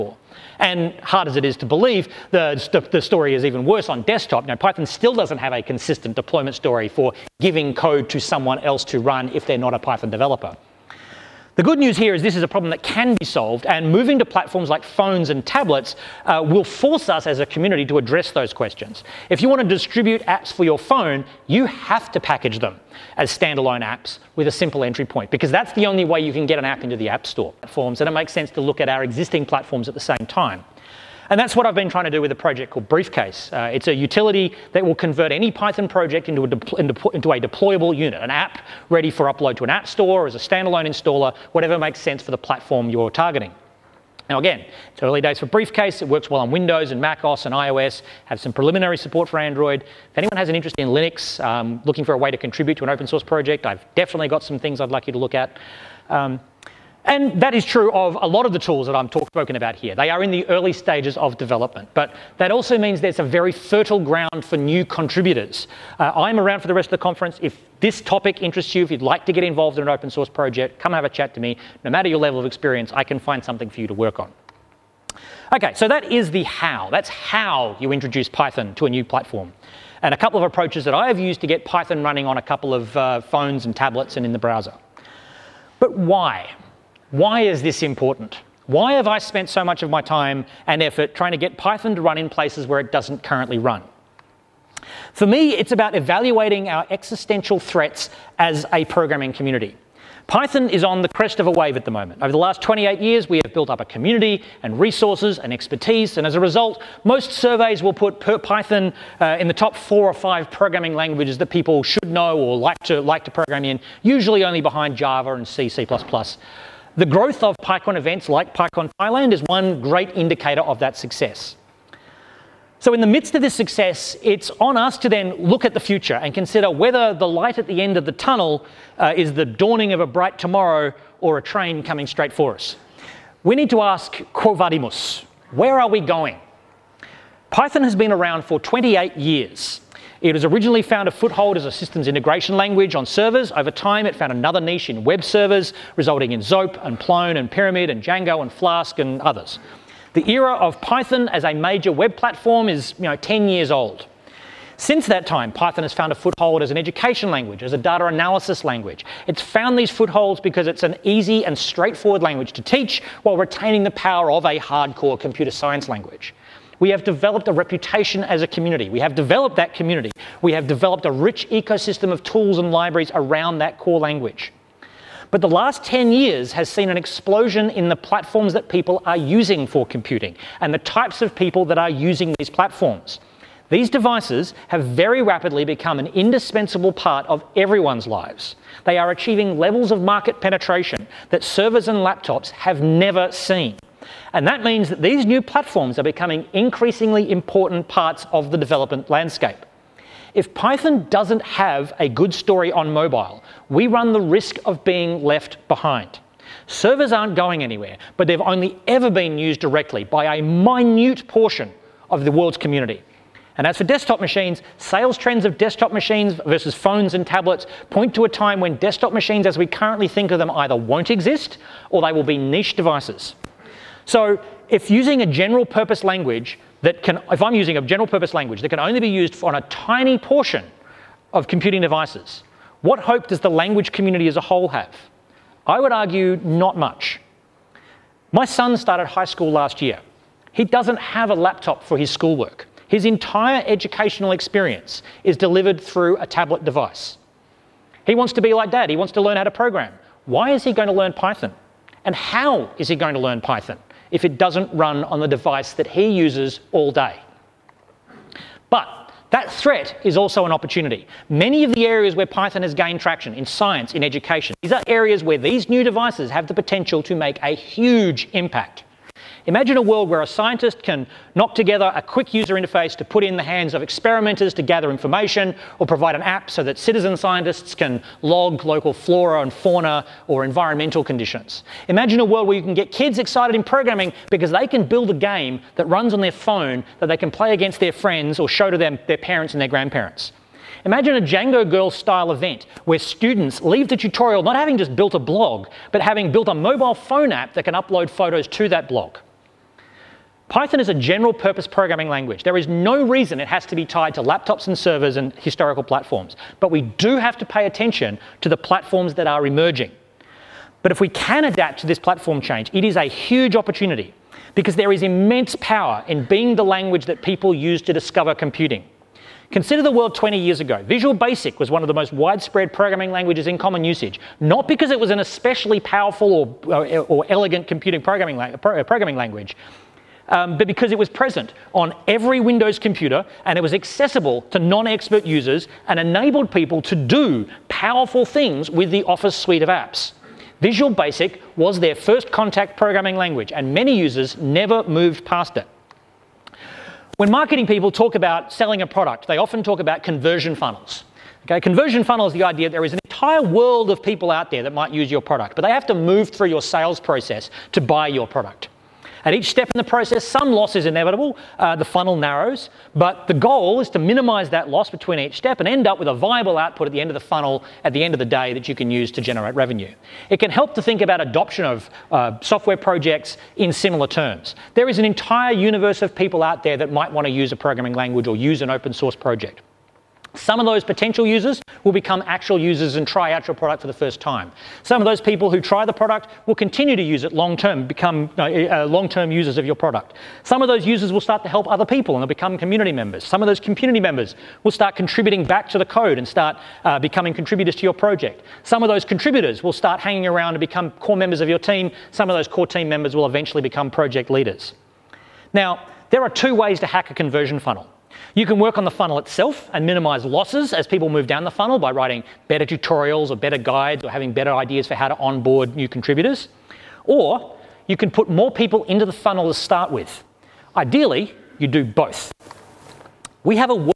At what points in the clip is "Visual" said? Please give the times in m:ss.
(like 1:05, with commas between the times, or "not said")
5:20, 5:40.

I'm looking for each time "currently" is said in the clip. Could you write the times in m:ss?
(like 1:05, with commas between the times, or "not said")
1:33, 3:39.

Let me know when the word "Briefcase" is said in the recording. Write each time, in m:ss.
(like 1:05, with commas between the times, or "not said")
0:32, 0:45.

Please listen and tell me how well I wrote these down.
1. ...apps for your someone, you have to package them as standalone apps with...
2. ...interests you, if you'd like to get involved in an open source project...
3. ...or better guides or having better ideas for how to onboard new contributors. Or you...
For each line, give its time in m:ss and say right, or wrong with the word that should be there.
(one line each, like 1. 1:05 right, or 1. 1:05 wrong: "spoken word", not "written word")
1. 0:20 wrong: "phone", not "someone"
2. 1:08 right
3. 6:53 right.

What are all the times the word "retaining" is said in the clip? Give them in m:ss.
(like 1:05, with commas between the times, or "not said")
2:43.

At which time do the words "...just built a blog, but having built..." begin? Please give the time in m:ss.
4:54.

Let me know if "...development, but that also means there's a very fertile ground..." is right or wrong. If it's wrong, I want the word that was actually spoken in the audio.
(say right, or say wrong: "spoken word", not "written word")
right.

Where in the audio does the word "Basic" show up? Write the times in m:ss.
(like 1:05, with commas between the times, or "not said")
5:21, 5:40.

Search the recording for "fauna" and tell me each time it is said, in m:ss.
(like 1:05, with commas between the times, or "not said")
4:39.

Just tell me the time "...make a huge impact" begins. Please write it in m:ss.
4:27.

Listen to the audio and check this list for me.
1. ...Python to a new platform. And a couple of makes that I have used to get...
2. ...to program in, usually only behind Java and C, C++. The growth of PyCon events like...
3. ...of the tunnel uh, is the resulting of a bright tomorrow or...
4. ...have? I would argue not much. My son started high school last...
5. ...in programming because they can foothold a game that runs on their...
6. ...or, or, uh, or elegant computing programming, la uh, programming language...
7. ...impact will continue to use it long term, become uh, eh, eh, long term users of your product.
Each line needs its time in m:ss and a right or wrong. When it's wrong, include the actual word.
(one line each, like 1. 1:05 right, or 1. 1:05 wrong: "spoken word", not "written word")
1. 1:18 wrong: "approaches", not "makes"
2. 1:53 right
3. 2:07 wrong: "dawning", not "resulting"
4. 3:54 right
5. 4:43 wrong: "build", not "foothold"
6. 5:26 right
7. 6:25 wrong: "product", not "impact".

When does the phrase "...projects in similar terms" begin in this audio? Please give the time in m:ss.
6:12.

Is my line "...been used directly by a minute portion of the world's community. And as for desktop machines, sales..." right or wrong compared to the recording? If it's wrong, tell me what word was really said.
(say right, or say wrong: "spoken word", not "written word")
right.